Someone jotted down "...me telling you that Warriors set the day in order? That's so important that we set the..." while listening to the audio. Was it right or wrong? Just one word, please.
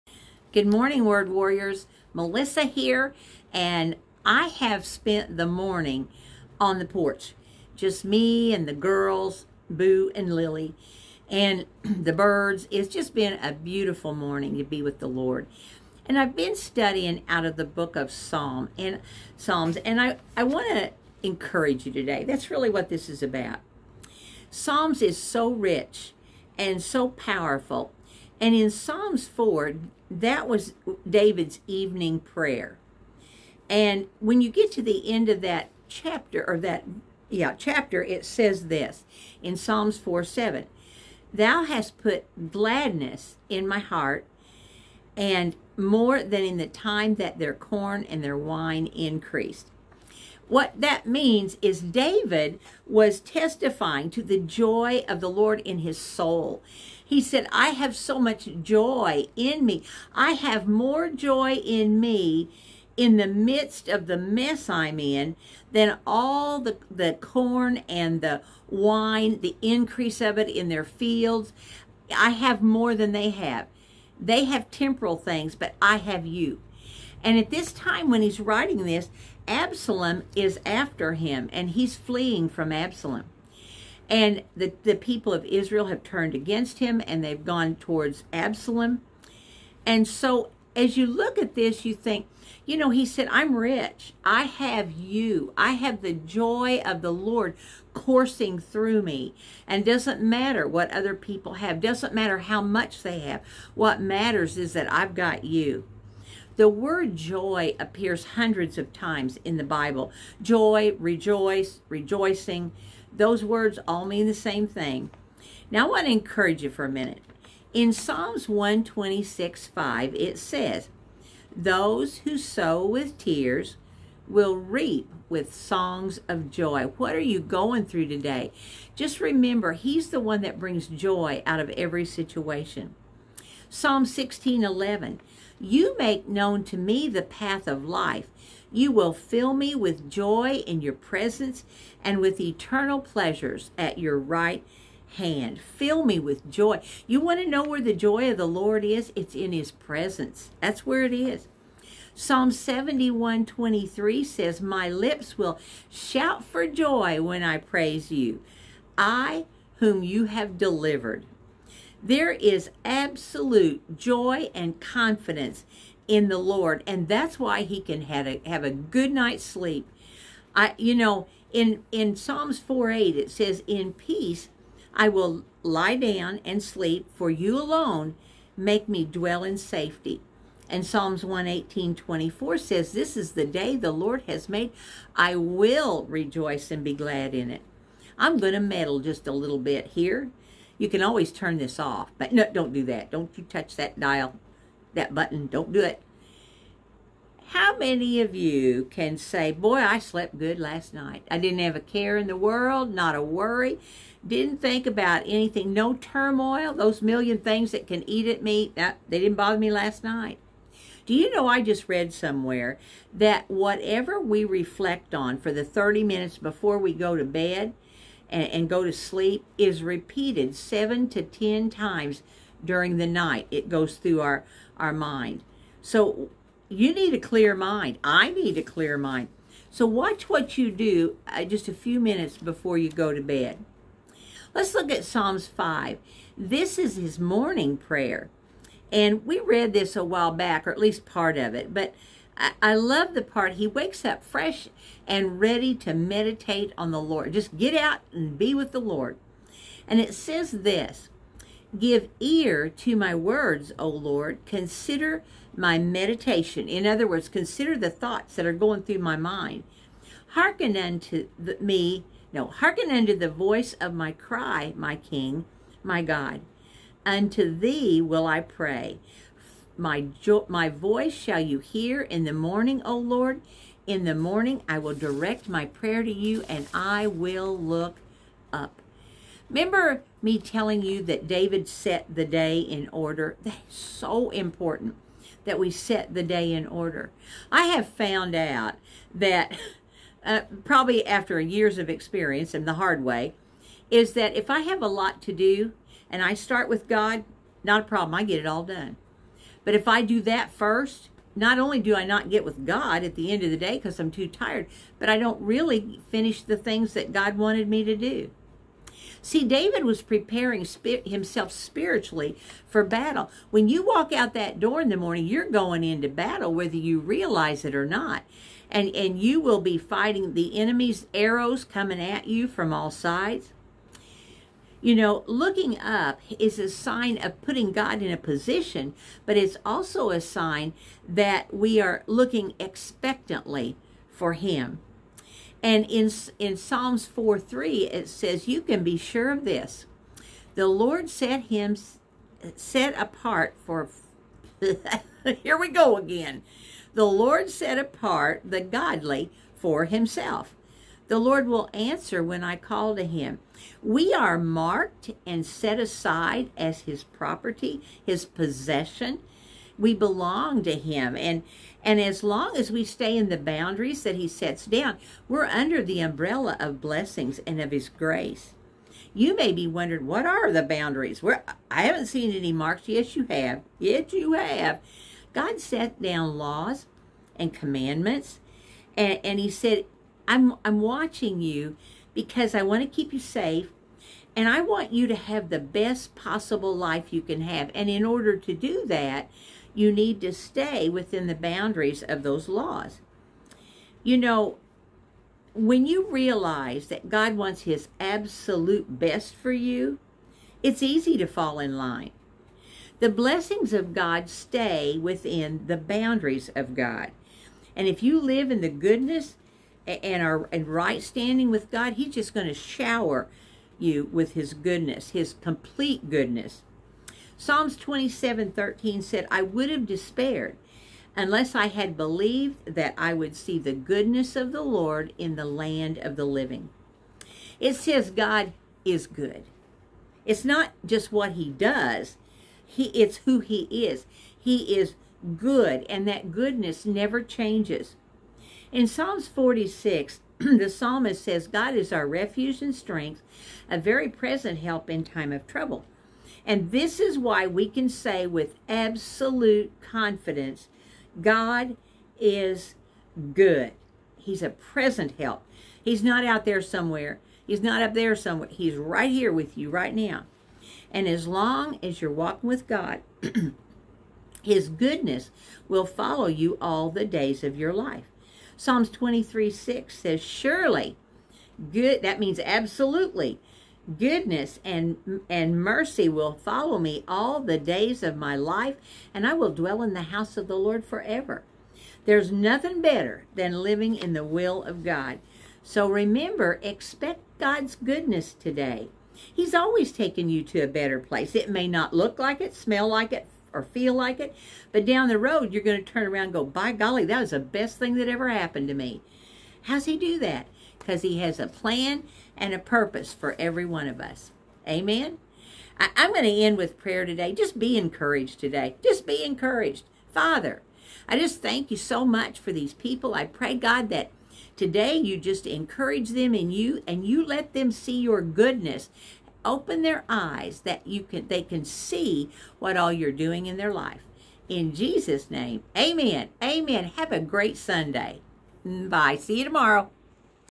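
wrong.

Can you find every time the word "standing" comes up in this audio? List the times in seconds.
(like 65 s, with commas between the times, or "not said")
411 s.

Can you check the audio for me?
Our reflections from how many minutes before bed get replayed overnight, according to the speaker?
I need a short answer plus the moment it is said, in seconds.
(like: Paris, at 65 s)
30, at 215 s.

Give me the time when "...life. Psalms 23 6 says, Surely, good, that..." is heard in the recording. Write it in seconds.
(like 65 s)
467 s.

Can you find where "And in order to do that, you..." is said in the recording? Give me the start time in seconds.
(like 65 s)
387 s.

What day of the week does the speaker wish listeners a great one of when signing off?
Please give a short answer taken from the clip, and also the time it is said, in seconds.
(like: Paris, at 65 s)
Sunday, at 527 s.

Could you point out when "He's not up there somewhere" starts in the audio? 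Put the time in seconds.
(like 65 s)
457 s.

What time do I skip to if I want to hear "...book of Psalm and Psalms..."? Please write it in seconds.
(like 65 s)
17 s.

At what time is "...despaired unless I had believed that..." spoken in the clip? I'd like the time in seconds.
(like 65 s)
419 s.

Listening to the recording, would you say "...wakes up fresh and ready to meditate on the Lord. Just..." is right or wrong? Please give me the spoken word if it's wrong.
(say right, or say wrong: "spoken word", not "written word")
right.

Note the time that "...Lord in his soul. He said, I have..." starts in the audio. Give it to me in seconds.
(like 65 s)
55 s.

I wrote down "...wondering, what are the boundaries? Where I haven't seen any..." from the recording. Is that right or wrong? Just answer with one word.
right.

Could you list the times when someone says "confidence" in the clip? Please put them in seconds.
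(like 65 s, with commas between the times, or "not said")
164 s, 449 s.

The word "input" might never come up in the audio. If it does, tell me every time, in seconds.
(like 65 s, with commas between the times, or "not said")
not said.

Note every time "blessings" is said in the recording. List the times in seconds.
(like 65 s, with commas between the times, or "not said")
366 s, 403 s.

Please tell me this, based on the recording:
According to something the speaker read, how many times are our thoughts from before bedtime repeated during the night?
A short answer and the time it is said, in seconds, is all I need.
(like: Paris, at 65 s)
7 to 10, at 220 s.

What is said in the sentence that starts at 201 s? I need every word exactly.
I didn't have a care in the world, not a worry.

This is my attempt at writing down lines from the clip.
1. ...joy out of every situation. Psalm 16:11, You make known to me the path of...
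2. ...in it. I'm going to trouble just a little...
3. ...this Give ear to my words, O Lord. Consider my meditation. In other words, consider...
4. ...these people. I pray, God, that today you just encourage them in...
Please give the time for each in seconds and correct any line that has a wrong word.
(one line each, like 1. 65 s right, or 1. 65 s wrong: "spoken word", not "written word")
1. 130 s right
2. 187 s wrong: "meddle", not "trouble"
3. 250 s right
4. 512 s right.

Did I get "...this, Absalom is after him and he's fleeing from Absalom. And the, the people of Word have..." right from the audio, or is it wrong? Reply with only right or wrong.
wrong.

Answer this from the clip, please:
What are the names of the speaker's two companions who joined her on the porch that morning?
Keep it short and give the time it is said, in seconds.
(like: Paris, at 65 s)
Boo and Lily, at 9 s.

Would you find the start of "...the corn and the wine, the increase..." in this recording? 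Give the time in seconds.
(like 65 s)
66 s.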